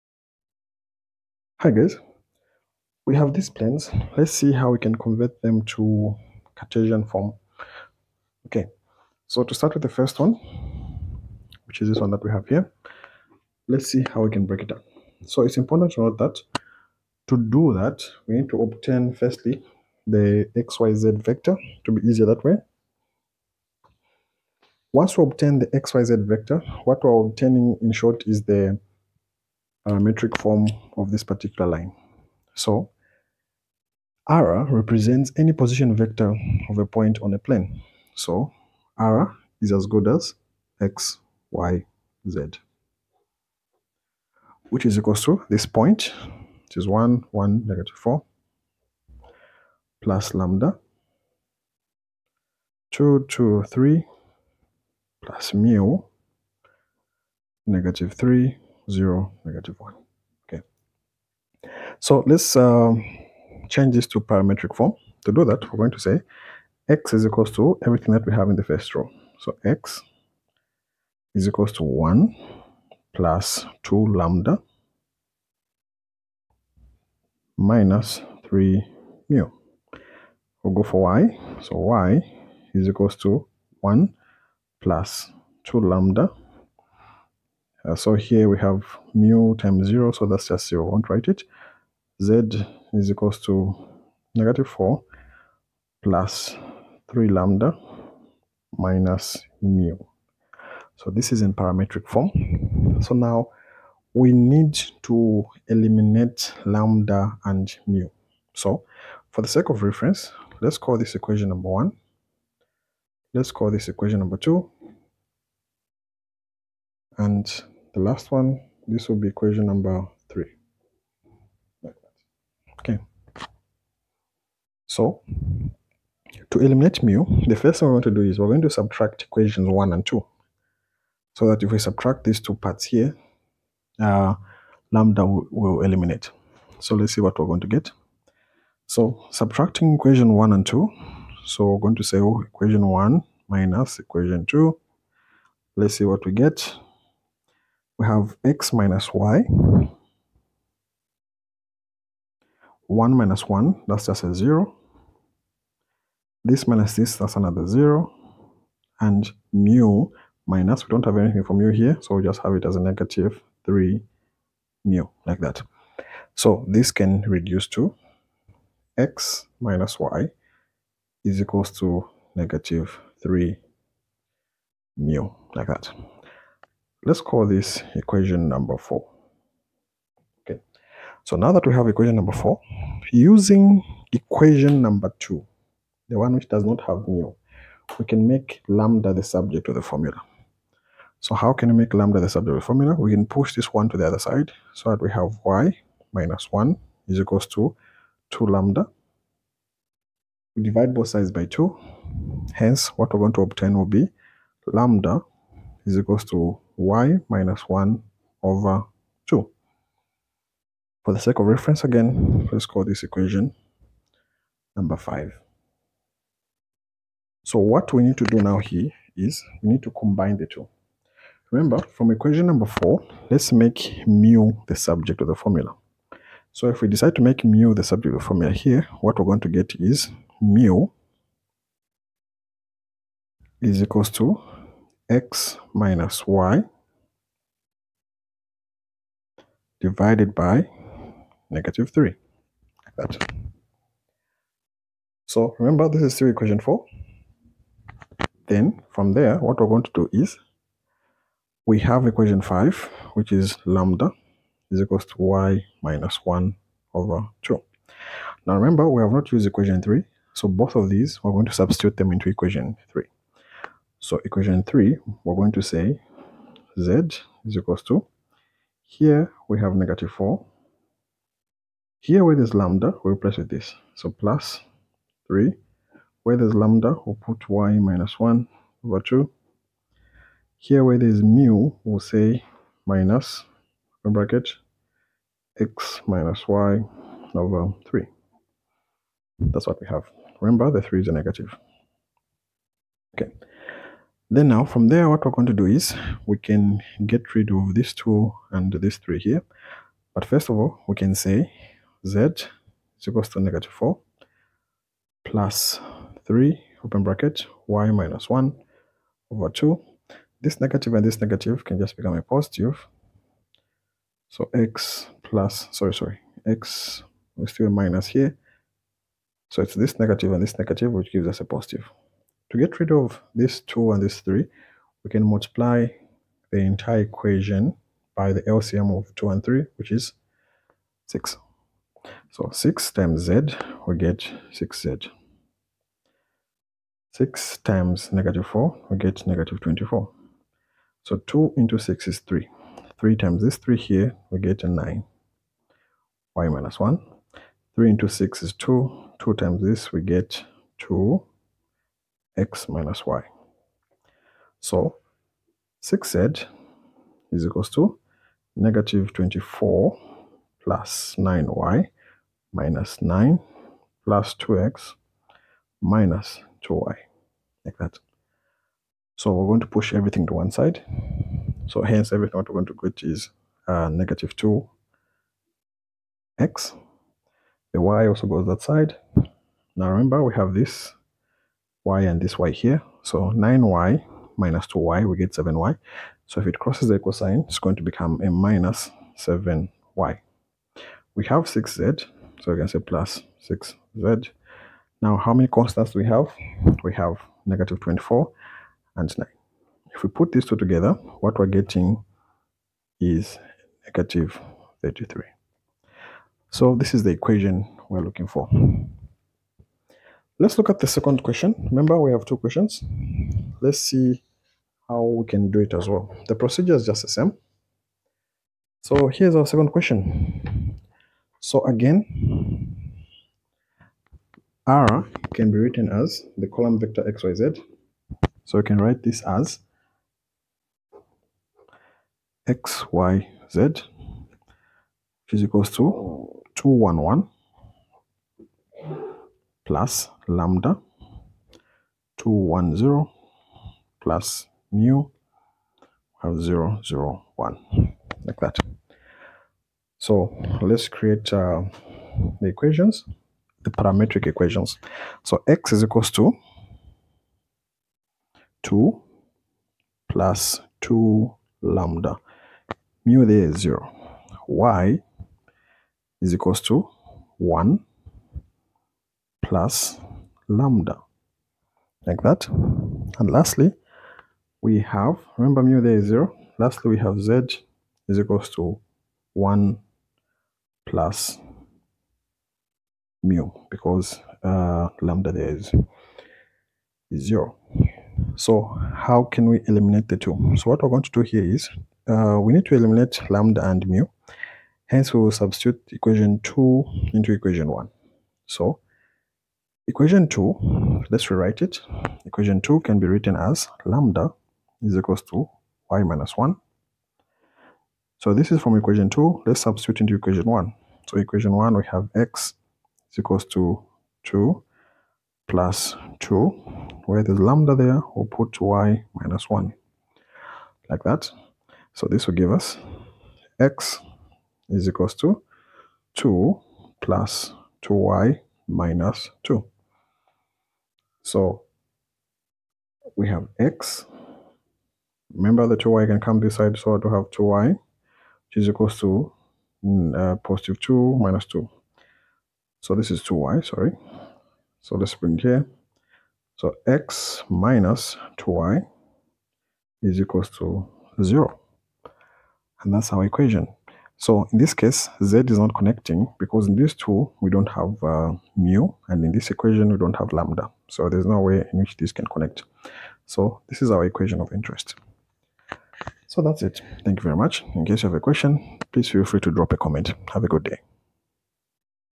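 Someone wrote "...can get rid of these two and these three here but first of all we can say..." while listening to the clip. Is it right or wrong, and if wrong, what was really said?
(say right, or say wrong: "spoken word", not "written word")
right.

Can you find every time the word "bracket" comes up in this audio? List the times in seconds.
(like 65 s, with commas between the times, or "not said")
284 s, 307 s.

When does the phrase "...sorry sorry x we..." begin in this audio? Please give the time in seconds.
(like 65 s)
315 s.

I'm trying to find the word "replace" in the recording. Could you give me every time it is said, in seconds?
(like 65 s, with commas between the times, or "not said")
273 s.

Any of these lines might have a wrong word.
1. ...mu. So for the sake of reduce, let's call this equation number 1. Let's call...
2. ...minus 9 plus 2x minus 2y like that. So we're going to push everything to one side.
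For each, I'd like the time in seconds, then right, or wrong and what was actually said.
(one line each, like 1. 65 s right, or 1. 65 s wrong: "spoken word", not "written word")
1. 107 s wrong: "reference", not "reduce"
2. 362 s right.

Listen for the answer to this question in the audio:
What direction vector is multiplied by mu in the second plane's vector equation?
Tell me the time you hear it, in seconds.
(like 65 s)
446 s.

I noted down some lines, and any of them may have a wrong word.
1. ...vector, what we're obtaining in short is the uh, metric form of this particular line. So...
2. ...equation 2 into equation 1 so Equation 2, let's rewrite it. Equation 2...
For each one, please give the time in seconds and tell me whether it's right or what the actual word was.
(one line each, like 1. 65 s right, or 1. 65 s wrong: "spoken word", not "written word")
1. 26 s right
2. 495 s right.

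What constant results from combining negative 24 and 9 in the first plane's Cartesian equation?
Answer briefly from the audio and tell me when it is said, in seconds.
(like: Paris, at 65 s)
-33, at 403 s.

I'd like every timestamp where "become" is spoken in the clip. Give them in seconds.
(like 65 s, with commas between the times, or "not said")
311 s, 387 s.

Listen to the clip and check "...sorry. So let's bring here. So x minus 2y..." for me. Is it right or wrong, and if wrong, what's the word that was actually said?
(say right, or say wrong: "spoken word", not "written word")
right.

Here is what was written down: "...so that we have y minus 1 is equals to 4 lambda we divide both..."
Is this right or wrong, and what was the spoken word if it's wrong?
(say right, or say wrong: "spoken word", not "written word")
wrong: "2", not "4".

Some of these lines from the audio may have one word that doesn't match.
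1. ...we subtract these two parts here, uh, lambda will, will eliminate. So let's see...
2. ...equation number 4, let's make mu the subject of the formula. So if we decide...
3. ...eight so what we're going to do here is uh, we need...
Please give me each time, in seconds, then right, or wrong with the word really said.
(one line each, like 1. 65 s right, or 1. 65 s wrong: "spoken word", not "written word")
1. 131 s right
2. 222 s right
3. 490 s wrong: "two", not "eight".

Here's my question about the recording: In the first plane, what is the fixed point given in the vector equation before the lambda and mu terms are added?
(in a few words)
1, 1, -4.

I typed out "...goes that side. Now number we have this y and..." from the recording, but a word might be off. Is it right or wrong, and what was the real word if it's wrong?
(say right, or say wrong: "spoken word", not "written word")
wrong: "remember", not "number".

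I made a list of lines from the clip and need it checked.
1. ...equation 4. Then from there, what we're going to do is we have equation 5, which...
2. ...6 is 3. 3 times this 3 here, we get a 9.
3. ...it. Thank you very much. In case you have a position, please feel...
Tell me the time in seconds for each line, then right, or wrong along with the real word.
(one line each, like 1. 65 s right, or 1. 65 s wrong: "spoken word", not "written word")
1. 246 s right
2. 341 s right
3. 566 s wrong: "question", not "position".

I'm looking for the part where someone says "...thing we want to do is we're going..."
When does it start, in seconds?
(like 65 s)
127 s.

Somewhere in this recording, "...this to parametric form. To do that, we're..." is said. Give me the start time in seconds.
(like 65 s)
63 s.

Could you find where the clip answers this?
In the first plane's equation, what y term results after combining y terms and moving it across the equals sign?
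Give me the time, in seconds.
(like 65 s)
388 s.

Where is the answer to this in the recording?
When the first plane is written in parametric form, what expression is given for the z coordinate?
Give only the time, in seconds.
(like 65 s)
94 s.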